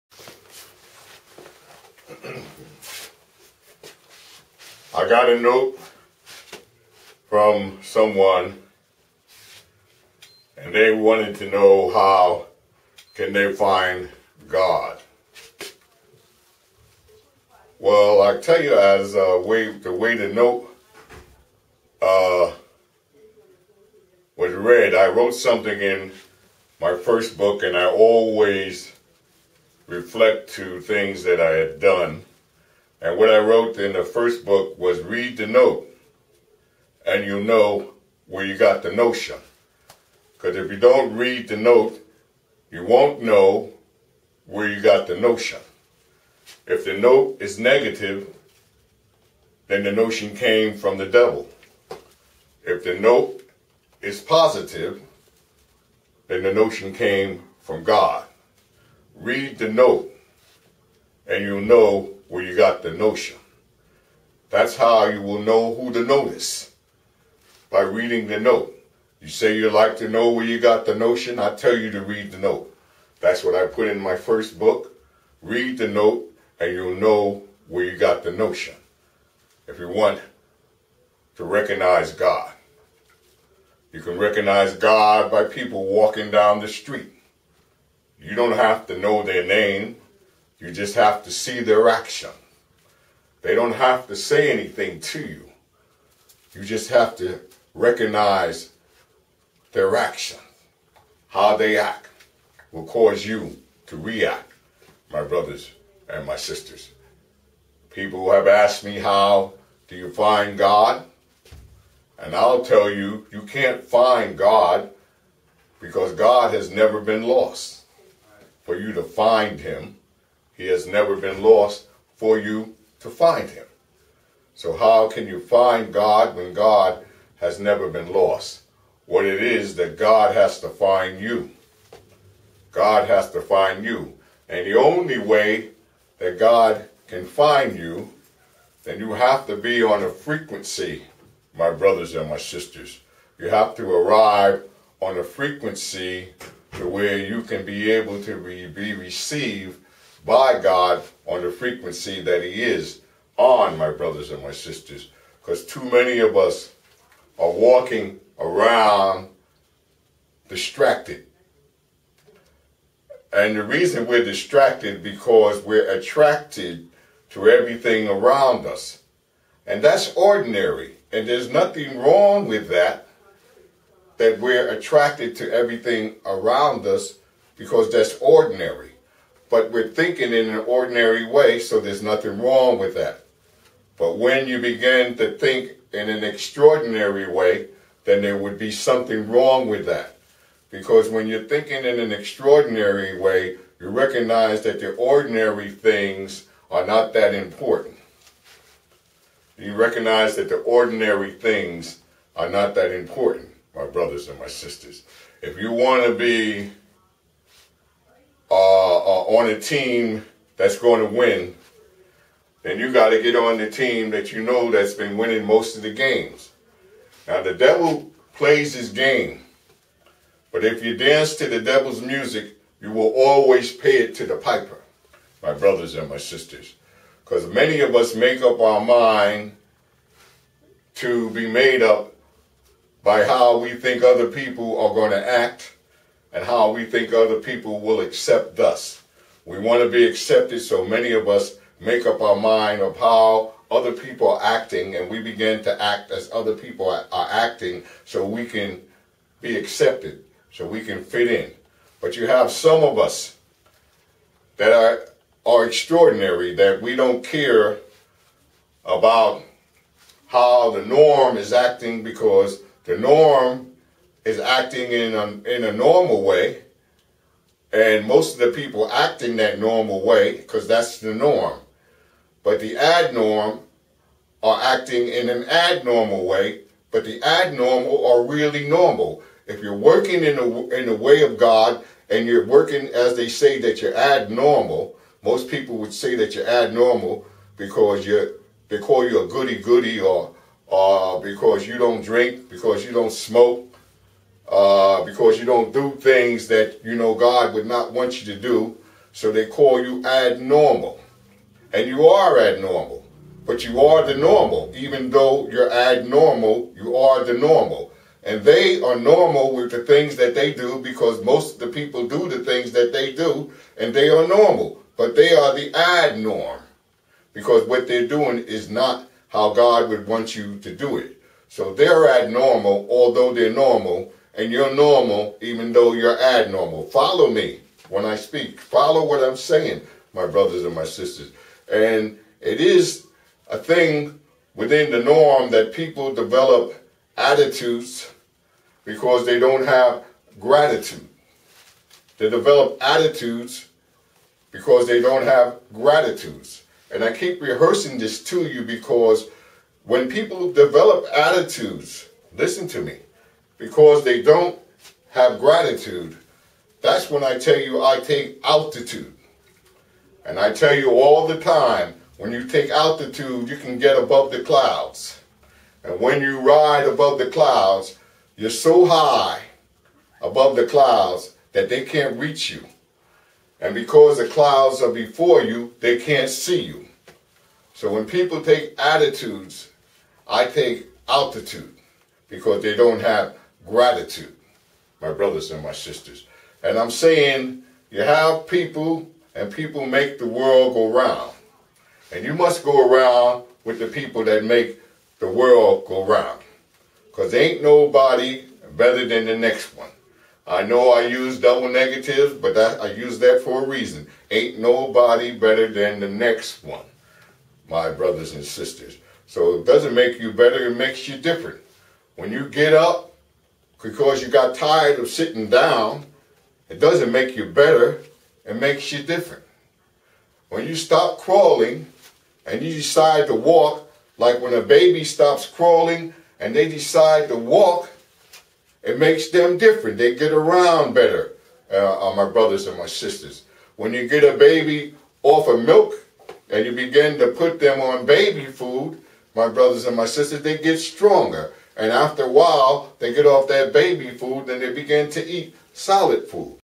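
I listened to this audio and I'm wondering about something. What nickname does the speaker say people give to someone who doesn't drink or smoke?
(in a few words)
Goody-goody.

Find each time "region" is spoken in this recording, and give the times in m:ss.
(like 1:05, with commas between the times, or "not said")
not said.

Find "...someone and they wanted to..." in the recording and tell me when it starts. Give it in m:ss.
0:07.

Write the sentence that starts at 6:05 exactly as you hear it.
And when you ride above the clouds, you're so high above the clouds that they can't reach you.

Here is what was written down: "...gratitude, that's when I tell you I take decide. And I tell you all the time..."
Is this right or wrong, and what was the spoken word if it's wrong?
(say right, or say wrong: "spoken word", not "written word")
wrong: "altitude", not "decide".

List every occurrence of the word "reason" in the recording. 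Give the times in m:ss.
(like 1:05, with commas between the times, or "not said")
2:43, 6:43.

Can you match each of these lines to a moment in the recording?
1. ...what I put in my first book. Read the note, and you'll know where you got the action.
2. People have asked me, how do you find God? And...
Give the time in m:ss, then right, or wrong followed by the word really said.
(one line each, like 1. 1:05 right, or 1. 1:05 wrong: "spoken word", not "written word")
1. 1:13 wrong: "notion", not "action"
2. 1:47 right.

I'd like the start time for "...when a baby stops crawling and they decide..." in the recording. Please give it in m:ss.
7:04.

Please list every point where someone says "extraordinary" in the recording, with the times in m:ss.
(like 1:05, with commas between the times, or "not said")
3:06, 3:12, 4:15.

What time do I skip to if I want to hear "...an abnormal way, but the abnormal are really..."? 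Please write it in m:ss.
4:35.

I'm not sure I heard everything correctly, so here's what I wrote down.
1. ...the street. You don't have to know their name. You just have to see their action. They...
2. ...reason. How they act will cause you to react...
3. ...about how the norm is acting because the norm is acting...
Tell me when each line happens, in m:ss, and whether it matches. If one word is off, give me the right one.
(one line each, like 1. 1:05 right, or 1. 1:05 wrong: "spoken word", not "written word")
1. 1:26 right
2. 1:39 wrong: "action", not "reason"
3. 4:18 right.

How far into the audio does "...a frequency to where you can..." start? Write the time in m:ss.
2:25.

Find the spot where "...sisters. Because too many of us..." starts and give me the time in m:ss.
2:34.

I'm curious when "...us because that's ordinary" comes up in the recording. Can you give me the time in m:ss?
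2:56.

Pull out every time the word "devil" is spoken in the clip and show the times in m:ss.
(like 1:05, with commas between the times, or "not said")
0:51, 3:37, 3:41.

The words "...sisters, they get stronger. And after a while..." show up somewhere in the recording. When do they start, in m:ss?
7:20.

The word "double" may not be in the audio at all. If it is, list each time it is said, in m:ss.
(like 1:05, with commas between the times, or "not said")
6:41.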